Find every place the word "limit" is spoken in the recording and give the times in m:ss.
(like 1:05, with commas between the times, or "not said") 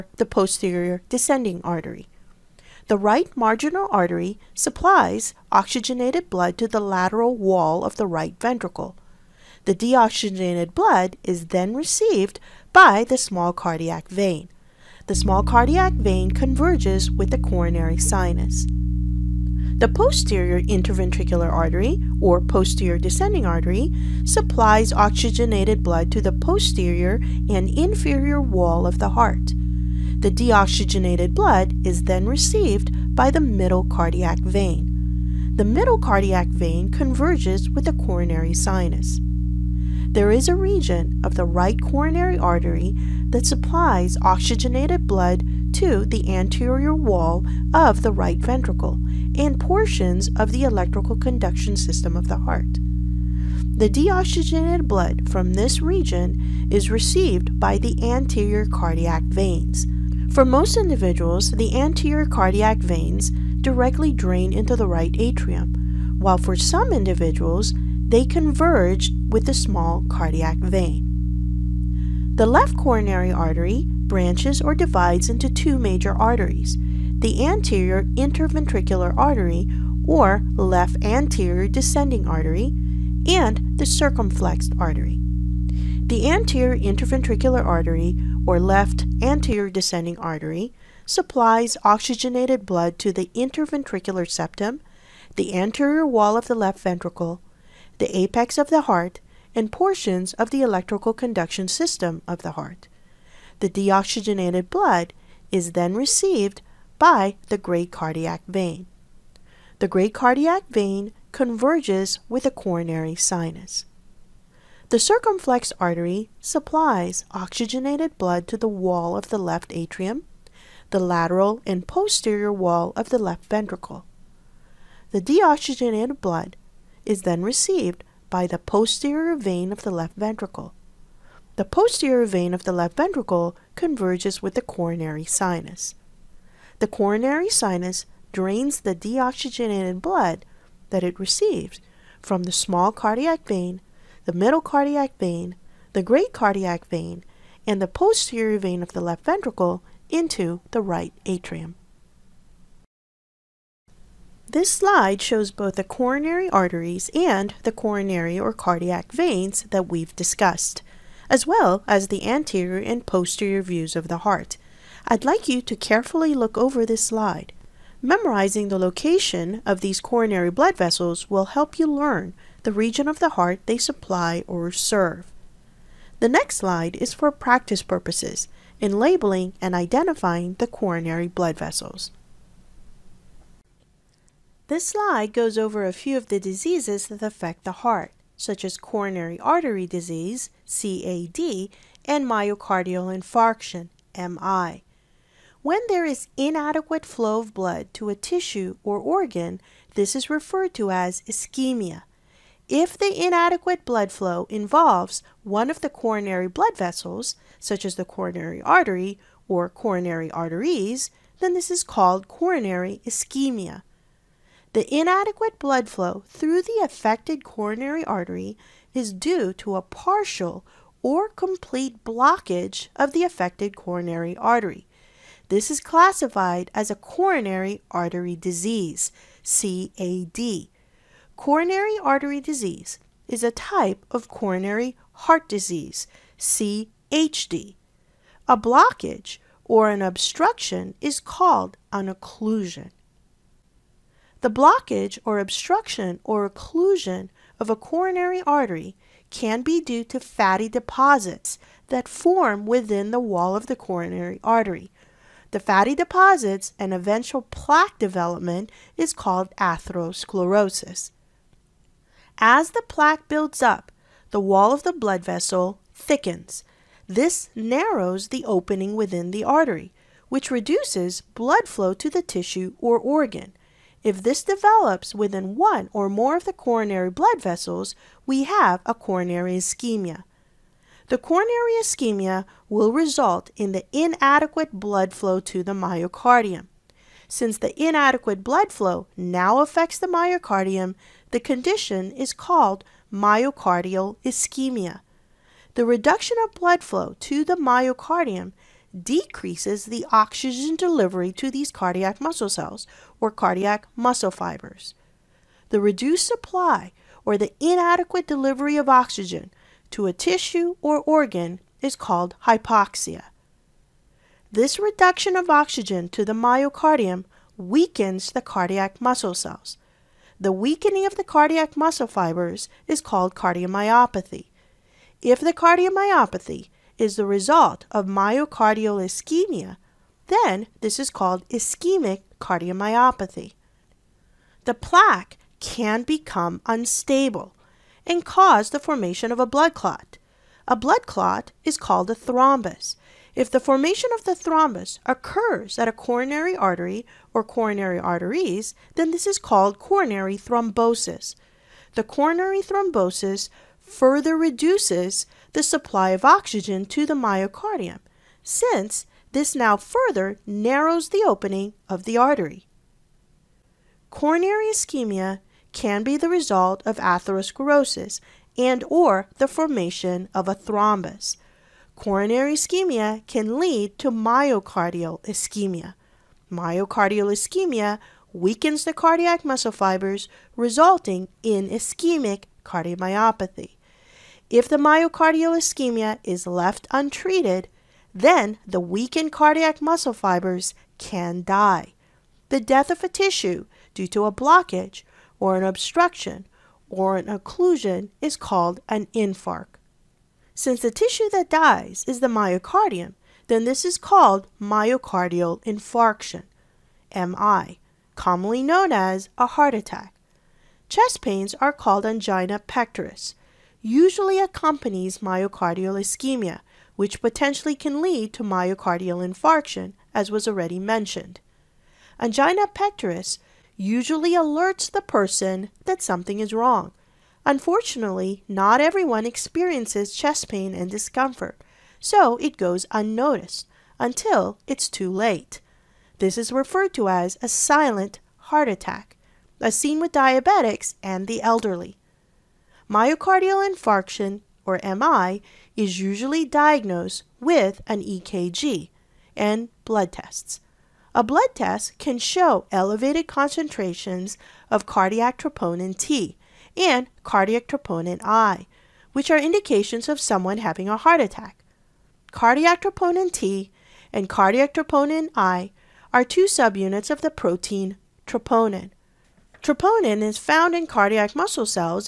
not said.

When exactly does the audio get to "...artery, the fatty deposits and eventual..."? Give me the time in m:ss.
4:14.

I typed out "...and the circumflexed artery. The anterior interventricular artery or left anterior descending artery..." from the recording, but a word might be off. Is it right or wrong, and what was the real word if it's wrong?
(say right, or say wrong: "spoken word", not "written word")
right.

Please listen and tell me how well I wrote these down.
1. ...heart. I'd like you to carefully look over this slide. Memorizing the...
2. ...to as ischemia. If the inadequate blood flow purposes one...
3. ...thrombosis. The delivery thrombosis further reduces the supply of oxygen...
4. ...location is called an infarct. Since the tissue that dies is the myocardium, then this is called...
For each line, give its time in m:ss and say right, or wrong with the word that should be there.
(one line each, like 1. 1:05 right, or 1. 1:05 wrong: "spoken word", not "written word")
1. 2:44 right
2. 3:20 wrong: "involves", not "purposes"
3. 5:50 wrong: "coronary", not "delivery"
4. 6:37 wrong: "occlusion", not "location".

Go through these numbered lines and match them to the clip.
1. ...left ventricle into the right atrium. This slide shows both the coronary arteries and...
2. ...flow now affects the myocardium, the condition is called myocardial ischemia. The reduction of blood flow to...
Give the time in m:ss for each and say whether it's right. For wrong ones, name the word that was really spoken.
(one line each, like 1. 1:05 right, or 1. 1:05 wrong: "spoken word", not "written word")
1. 2:29 right
2. 4:48 right.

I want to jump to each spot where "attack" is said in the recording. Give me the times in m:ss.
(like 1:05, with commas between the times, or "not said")
6:49, 7:18, 7:41.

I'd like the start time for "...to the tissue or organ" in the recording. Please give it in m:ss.
4:31.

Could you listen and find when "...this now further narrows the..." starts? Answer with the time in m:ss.
5:59.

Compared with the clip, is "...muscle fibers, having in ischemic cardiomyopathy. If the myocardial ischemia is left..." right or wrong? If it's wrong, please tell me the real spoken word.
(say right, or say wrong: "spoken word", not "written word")
wrong: "resulting", not "having".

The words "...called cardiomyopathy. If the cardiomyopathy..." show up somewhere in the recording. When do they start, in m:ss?
5:23.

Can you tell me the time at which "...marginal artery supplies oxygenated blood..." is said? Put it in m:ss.
0:03.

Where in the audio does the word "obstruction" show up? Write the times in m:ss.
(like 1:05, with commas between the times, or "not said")
4:00, 4:05, 6:35.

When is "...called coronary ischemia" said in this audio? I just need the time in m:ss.
3:31.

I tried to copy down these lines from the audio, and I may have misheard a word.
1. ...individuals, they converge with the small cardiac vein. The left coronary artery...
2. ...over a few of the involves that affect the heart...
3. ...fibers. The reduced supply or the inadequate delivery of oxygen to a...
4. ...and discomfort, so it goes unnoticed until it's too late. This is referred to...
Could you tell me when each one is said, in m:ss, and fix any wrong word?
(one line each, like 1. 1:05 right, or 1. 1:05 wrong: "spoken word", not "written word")
1. 1:06 right
2. 3:05 wrong: "diseases", not "involves"
3. 5:04 right
4. 7:10 right.